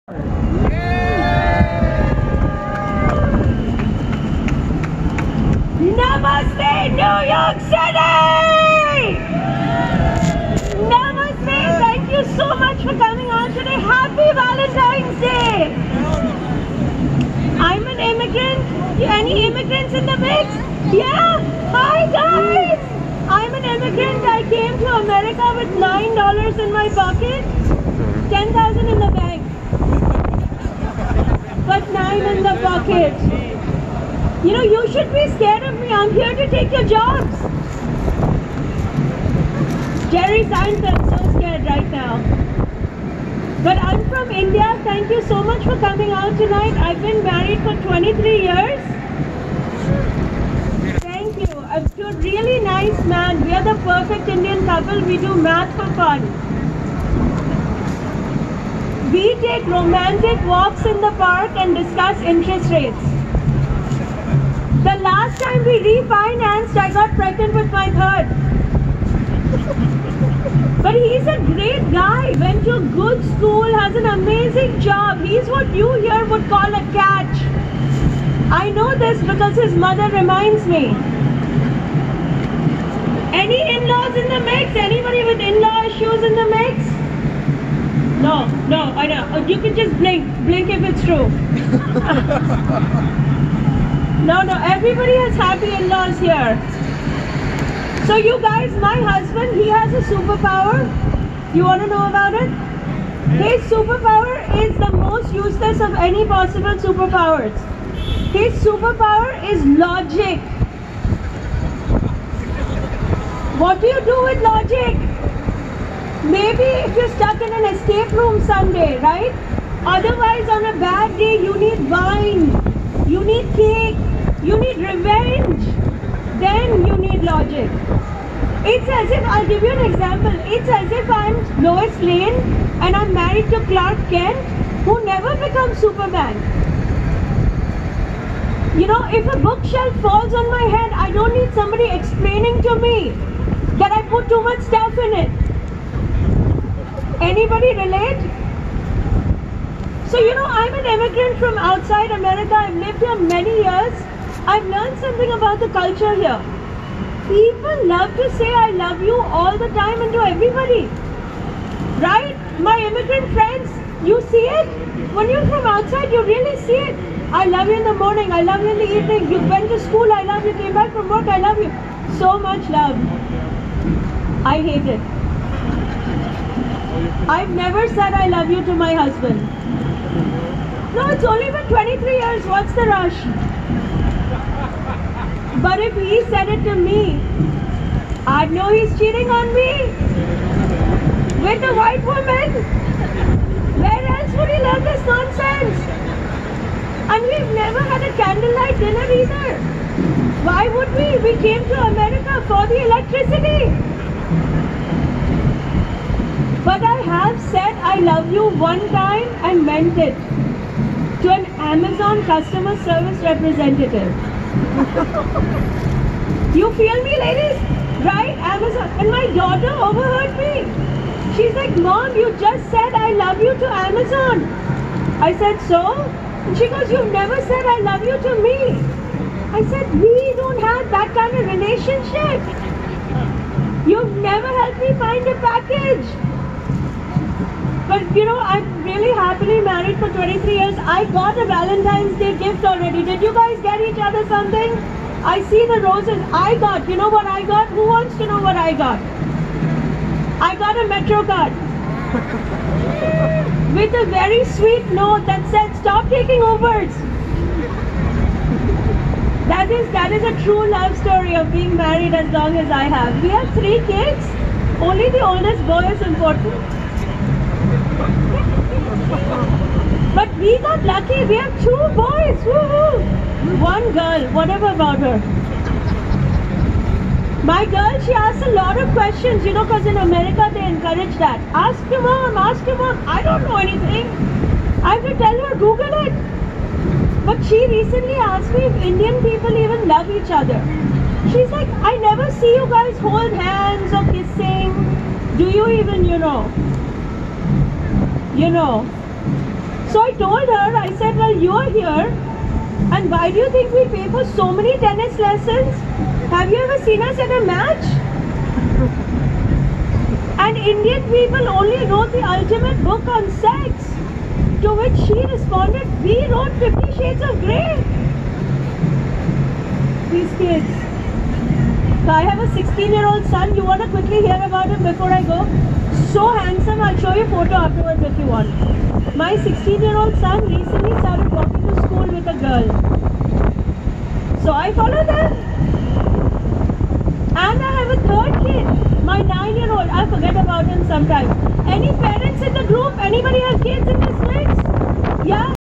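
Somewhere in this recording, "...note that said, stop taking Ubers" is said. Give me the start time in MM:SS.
04:15.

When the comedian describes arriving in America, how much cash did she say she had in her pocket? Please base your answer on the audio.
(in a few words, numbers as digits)
$9.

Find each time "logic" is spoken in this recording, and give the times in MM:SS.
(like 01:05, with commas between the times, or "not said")
01:49, 01:54, 02:07.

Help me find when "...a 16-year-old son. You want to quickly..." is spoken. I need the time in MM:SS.
05:22.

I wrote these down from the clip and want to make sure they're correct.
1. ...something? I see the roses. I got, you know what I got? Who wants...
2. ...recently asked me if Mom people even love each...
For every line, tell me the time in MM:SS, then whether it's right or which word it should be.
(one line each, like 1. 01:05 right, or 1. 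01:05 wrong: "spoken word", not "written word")
1. 04:04 right
2. 04:47 wrong: "Indian", not "Mom".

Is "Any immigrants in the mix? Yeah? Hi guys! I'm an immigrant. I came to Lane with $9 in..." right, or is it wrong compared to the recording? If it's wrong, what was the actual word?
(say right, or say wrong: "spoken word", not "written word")
wrong: "America", not "Lane".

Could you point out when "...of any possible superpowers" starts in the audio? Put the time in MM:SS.
01:45.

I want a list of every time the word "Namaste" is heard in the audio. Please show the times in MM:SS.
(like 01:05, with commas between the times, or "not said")
00:05, 00:10.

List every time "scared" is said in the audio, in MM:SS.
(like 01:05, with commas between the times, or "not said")
00:35, 00:41.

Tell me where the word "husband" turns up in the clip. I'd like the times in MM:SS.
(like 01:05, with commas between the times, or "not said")
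01:38, 02:58.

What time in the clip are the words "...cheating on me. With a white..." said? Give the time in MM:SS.
03:08.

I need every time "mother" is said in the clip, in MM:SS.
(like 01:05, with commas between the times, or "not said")
01:19.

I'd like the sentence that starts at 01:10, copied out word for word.
But he's a great guy, went to a good school, has an amazing job.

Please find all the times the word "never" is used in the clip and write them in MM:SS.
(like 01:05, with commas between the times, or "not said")
02:15, 02:57, 03:17, 03:47, 03:54, 04:51.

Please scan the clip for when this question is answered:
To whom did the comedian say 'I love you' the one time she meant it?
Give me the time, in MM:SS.
03:31.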